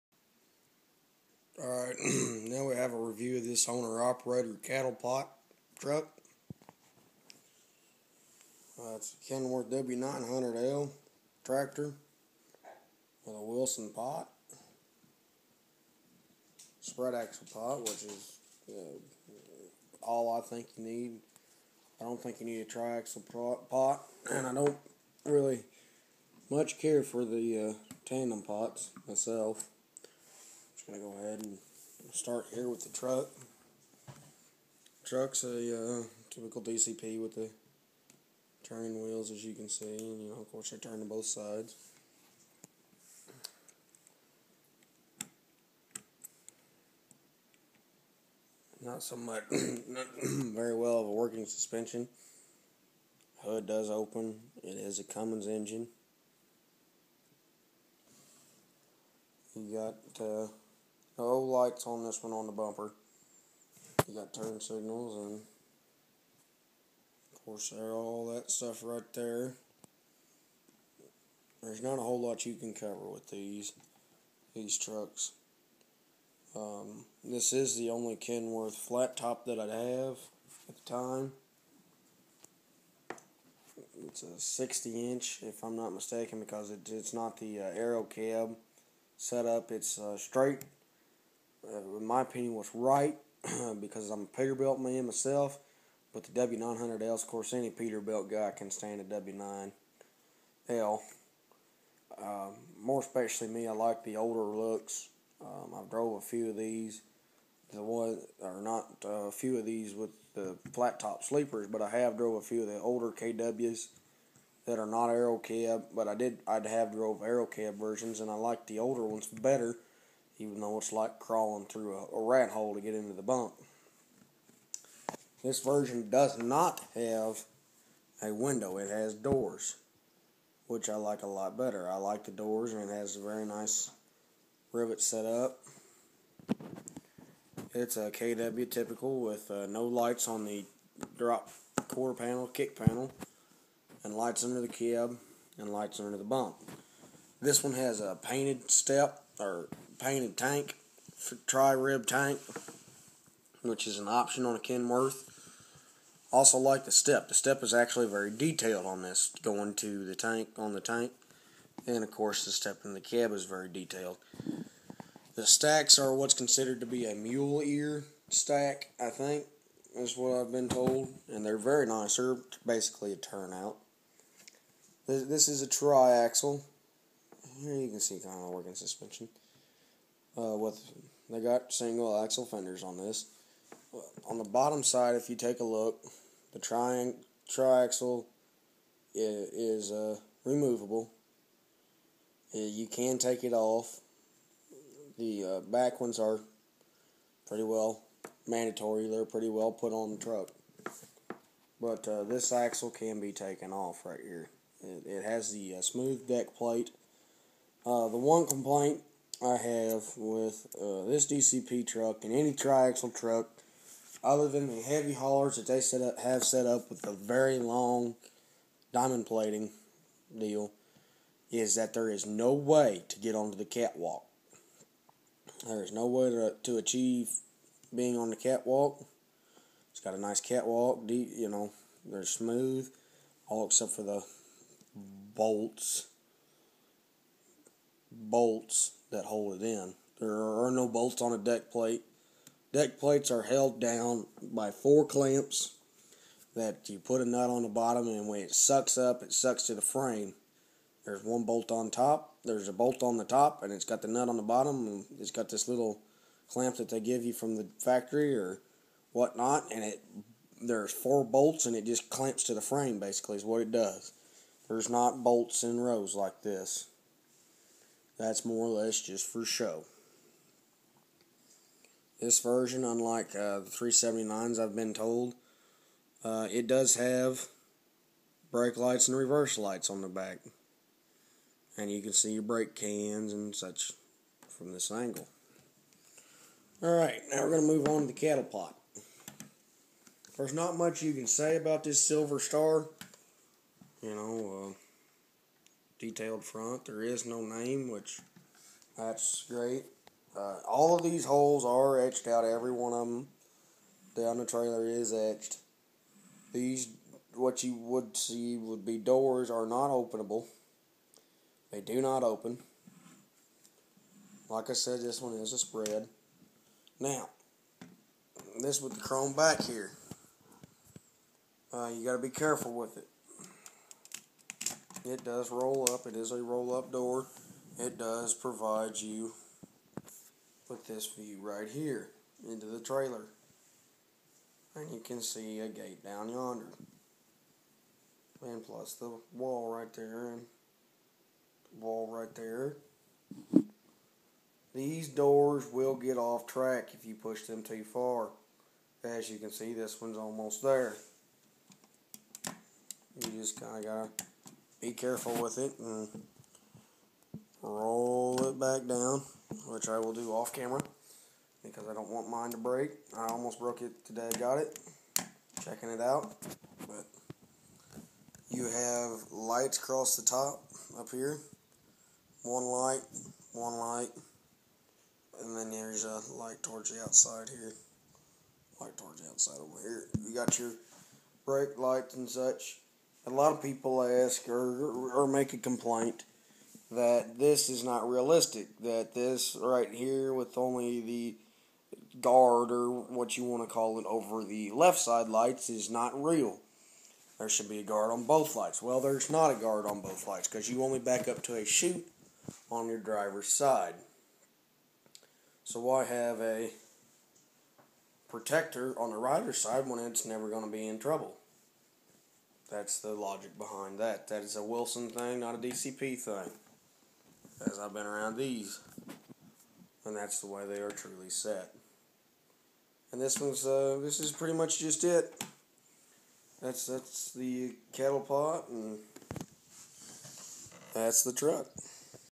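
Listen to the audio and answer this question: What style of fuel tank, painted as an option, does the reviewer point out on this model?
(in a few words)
Tri-rib tank.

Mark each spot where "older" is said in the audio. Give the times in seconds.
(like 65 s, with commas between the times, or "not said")
104 s, 112 s, 118 s.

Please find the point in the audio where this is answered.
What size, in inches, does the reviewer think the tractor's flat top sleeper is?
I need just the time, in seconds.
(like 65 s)
84 s.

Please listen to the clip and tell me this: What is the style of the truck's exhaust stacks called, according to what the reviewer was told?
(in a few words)
Mule ear stack.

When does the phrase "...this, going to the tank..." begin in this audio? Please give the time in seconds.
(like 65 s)
159 s.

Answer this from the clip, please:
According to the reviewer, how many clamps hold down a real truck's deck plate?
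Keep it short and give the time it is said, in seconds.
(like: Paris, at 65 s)
4, at 244 s.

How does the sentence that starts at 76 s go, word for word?
Um, this is the only Kenworth flat top that I have at the time.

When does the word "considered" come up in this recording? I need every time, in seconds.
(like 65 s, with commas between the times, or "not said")
166 s.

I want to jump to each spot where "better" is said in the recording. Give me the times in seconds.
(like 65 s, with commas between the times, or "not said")
119 s, 131 s.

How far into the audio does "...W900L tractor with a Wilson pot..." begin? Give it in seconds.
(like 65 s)
9 s.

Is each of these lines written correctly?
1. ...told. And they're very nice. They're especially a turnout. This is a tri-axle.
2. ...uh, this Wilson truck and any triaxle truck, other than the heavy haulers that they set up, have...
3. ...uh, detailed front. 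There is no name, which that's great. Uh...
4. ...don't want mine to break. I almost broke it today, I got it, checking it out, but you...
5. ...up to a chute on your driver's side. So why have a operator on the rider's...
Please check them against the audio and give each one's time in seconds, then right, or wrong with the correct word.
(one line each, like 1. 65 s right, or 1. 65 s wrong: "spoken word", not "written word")
1. 170 s wrong: "basically", not "especially"
2. 210 s wrong: "DCP", not "Wilson"
3. 294 s right
4. 361 s right
5. 401 s wrong: "protector", not "operator".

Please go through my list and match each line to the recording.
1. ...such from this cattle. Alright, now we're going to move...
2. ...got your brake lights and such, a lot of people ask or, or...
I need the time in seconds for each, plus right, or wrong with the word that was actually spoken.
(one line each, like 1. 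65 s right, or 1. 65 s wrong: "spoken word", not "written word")
1. 283 s wrong: "angle", not "cattle"
2. 380 s right.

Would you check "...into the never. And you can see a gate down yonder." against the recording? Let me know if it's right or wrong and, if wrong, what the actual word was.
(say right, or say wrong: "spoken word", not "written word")
wrong: "trailer", not "never".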